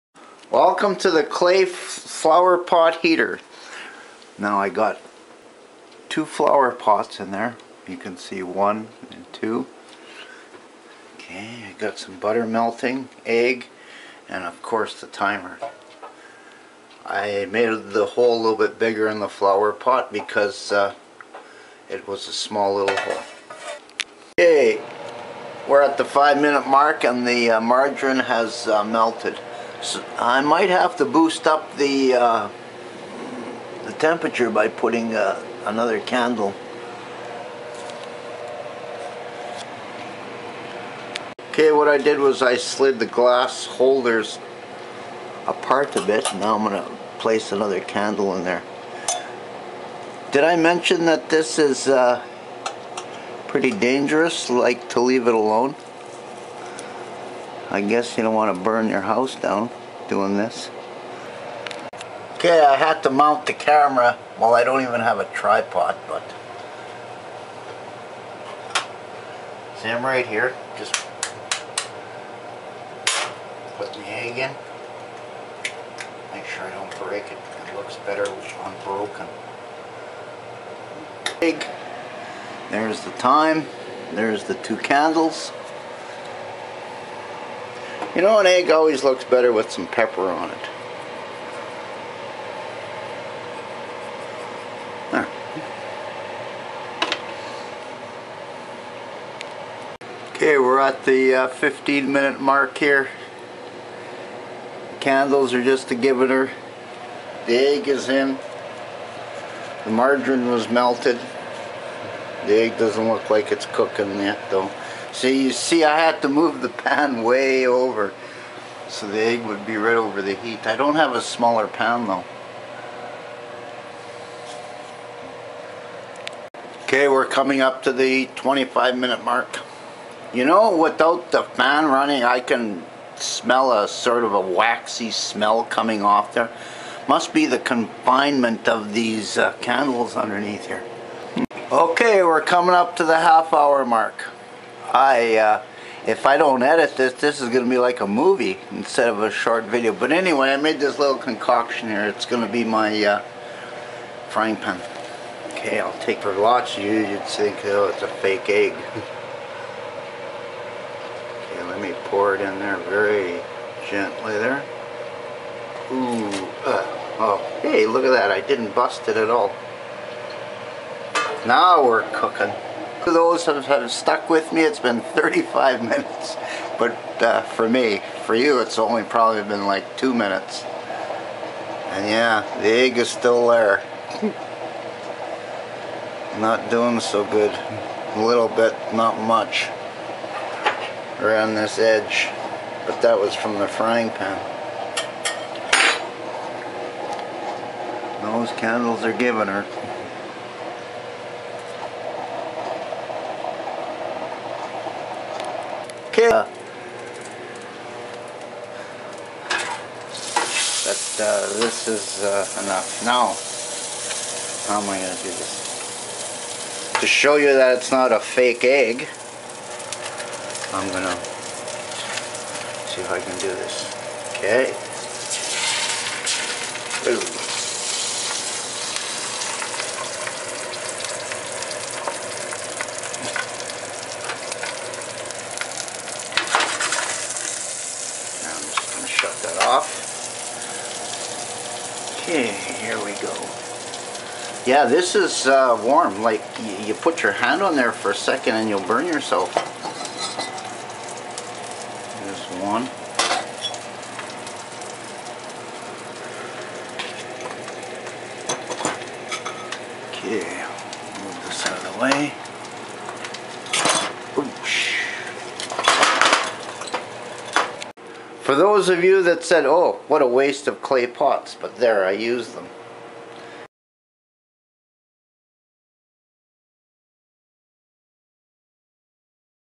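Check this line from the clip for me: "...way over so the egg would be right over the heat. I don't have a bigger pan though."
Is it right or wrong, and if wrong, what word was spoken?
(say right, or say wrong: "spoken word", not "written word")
wrong: "smaller", not "bigger".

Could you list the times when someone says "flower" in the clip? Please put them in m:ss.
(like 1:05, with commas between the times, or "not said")
0:01, 0:06, 0:19.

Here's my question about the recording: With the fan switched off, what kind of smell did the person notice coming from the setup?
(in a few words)
Waxy smell.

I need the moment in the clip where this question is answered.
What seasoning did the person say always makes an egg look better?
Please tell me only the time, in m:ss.
1:29.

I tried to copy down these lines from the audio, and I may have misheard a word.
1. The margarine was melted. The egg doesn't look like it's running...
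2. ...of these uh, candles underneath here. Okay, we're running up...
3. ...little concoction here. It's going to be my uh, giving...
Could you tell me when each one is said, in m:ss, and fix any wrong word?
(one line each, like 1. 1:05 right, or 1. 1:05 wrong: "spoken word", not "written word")
1. 1:49 wrong: "cooking", not "running"
2. 2:18 wrong: "coming", not "running"
3. 2:30 wrong: "frying", not "giving".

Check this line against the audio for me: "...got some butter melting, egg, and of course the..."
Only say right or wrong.
right.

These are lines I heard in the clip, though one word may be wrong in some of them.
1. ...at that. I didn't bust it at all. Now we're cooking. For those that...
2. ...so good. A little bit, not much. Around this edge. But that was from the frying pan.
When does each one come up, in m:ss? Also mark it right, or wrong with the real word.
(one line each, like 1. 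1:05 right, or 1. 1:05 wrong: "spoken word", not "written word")
1. 2:48 right
2. 3:06 right.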